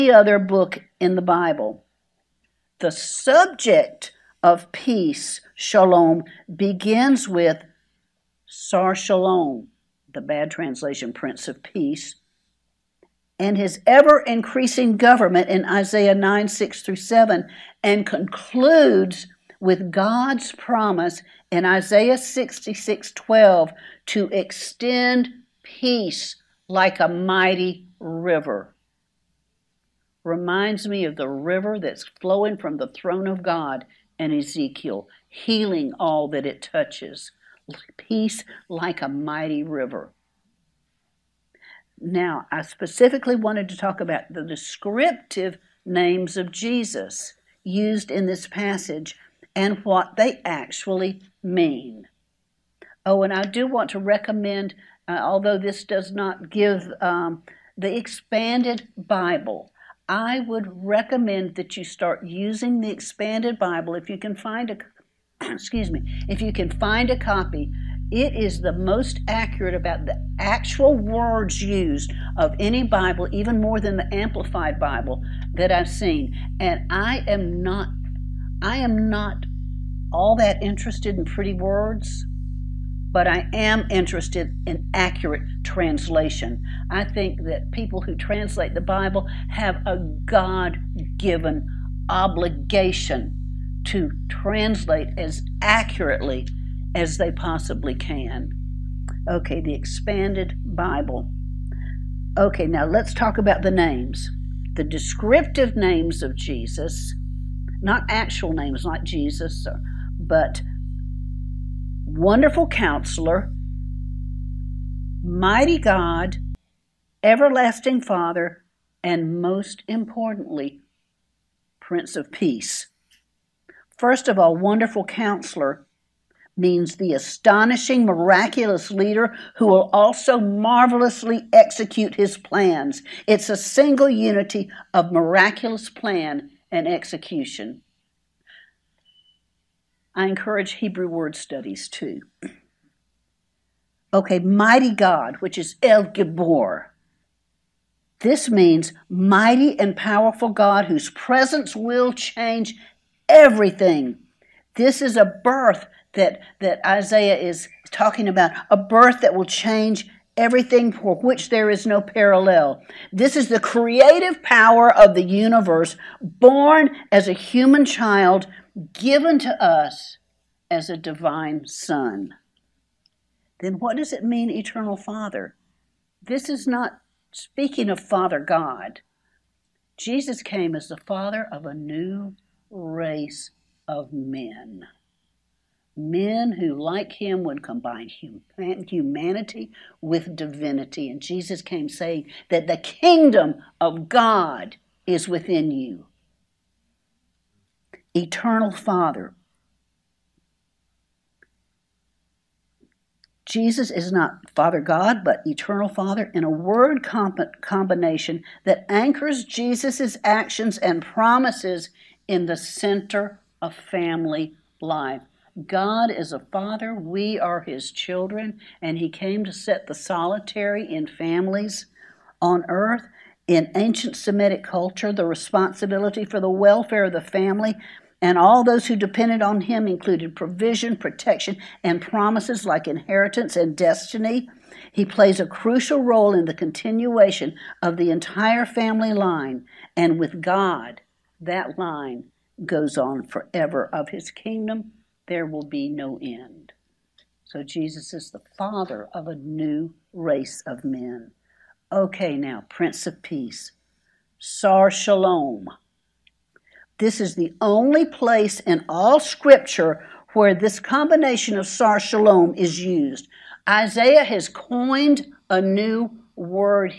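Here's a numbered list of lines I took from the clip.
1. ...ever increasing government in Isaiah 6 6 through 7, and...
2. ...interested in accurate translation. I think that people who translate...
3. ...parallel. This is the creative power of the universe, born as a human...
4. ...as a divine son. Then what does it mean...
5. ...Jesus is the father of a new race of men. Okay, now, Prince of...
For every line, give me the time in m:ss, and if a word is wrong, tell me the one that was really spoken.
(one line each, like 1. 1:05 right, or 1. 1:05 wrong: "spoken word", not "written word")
1. 0:13 wrong: "9", not "6"
2. 1:23 right
3. 2:42 right
4. 2:50 right
5. 4:07 right.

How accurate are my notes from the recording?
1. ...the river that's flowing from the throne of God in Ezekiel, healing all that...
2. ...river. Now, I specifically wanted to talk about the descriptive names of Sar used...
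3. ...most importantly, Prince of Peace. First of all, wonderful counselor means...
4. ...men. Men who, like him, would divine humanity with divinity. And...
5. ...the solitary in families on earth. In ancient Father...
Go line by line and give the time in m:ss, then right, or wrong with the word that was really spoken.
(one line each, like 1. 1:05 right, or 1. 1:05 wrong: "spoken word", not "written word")
1. 0:31 right
2. 0:39 wrong: "Jesus", not "Sar"
3. 1:59 right
4. 3:04 wrong: "combine", not "divine"
5. 3:39 wrong: "Semitic", not "Father".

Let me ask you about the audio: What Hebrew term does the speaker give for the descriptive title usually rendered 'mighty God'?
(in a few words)
El Gibor.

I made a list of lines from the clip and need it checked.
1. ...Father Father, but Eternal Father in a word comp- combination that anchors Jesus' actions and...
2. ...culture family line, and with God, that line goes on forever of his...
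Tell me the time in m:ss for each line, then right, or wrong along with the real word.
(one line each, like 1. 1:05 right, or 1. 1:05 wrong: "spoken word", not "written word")
1. 3:24 wrong: "God", not "Father"
2. 3:58 wrong: "entire", not "culture".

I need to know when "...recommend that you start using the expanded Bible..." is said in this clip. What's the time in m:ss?
1:00.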